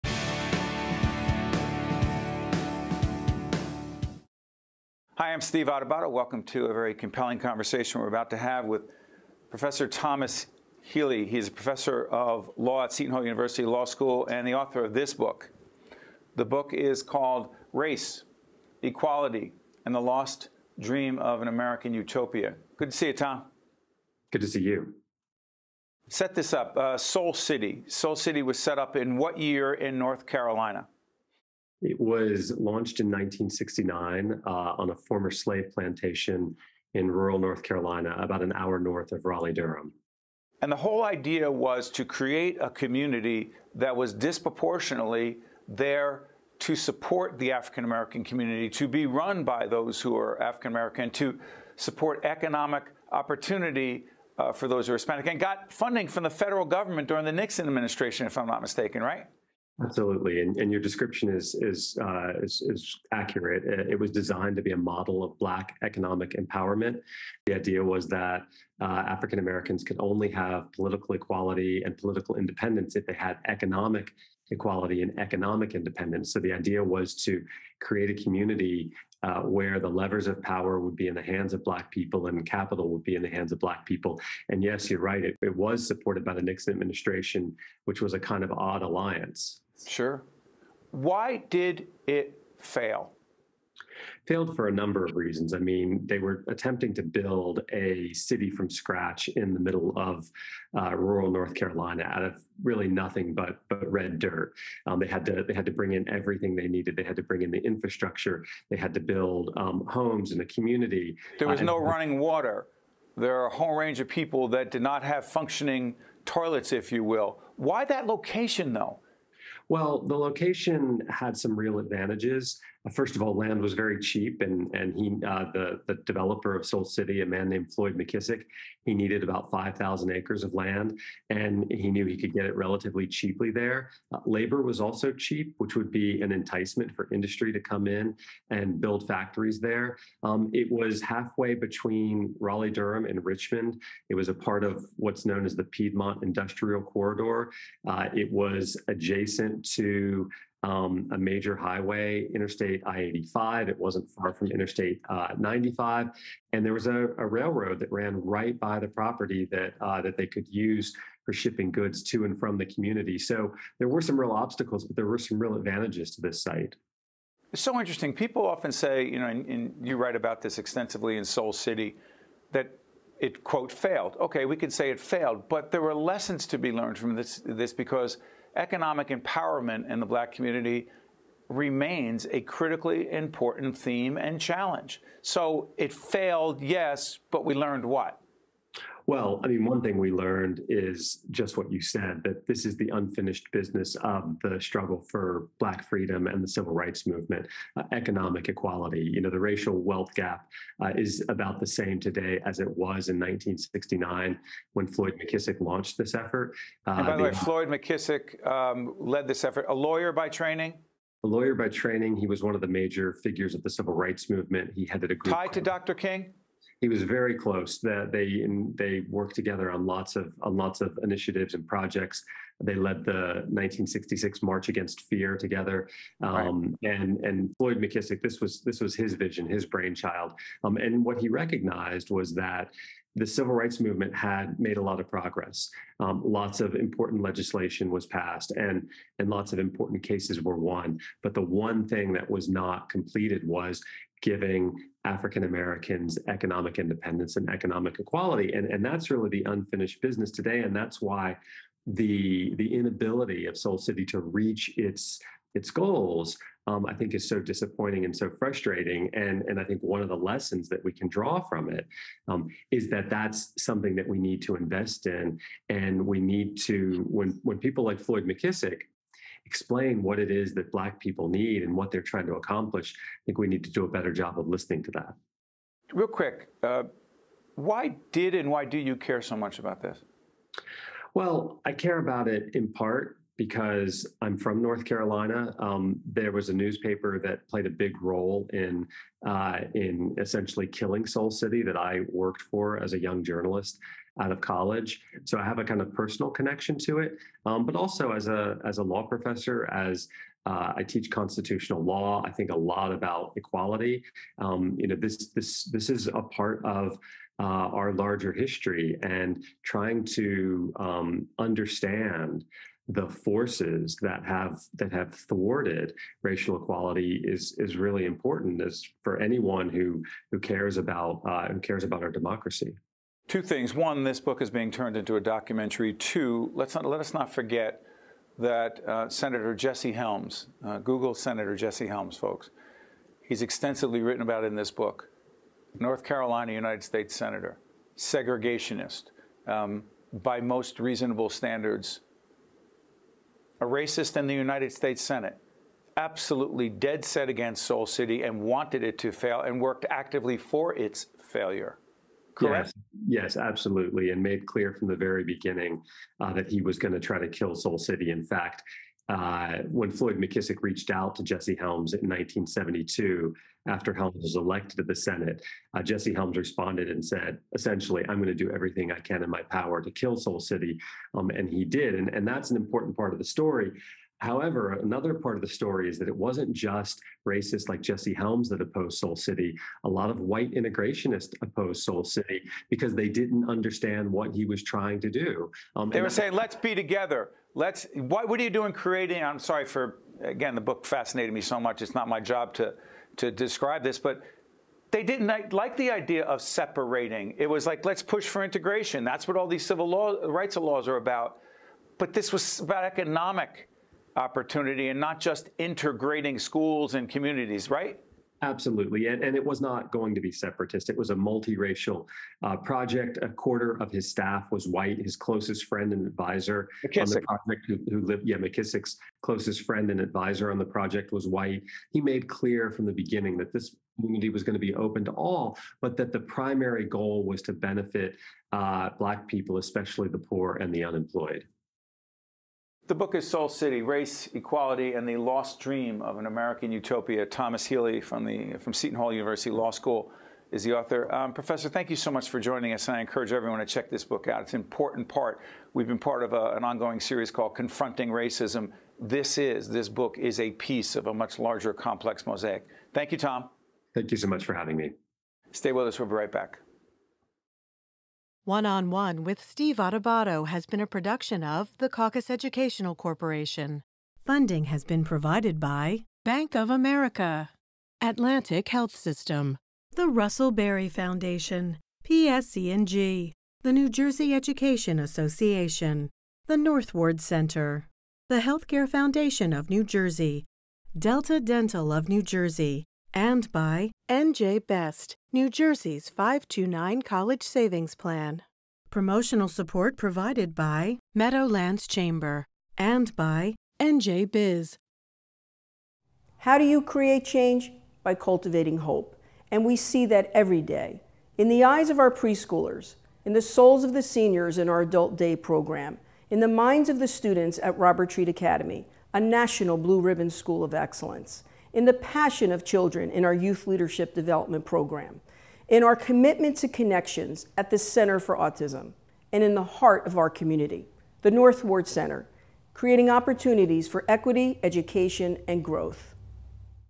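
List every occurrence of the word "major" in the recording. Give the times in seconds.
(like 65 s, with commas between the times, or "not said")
151 s, 212 s.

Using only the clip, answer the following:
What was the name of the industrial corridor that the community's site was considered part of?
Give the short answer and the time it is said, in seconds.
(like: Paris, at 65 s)
Piedmont Industrial Corridor, at 145 s.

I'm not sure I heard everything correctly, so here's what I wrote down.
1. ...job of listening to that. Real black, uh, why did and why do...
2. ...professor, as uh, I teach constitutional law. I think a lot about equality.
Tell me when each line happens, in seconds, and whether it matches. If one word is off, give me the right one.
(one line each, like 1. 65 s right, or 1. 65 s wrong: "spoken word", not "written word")
1. 274 s wrong: "quick", not "black"
2. 299 s right.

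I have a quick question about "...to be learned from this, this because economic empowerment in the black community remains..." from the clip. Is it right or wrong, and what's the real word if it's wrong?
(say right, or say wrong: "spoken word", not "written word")
right.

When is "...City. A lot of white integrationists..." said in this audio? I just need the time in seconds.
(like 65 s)
379 s.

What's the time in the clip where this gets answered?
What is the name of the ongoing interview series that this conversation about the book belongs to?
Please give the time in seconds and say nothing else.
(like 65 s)
447 s.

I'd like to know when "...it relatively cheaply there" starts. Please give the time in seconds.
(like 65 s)
132 s.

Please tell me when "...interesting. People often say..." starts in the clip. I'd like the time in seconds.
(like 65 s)
167 s.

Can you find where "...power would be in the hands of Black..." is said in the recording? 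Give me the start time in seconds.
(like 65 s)
80 s.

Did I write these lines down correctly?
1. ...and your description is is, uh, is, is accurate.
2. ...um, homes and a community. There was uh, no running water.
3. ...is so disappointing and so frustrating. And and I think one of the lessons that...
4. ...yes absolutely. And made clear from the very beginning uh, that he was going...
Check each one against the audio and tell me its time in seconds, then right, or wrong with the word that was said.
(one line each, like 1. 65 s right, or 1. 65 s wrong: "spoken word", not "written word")
1. 60 s right
2. 109 s right
3. 257 s right
4. 353 s right.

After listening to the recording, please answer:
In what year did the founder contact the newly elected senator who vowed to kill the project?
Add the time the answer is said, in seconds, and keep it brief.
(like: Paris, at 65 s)
1972, at 361 s.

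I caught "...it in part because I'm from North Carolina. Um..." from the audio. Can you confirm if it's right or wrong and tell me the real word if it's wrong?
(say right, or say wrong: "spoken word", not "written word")
right.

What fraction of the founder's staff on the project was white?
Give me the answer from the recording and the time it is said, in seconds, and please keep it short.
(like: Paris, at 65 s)
A quarter, at 413 s.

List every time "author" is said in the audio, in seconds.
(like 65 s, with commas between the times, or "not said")
14 s, 440 s.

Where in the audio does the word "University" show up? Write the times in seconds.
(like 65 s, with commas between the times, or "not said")
13 s, 439 s.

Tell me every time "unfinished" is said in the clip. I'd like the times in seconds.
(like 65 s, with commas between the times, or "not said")
192 s, 249 s.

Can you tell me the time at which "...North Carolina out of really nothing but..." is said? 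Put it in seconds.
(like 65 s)
101 s.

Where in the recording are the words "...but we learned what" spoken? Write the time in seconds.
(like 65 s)
187 s.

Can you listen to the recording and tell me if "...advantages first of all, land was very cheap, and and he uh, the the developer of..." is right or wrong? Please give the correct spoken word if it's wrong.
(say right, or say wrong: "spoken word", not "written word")
right.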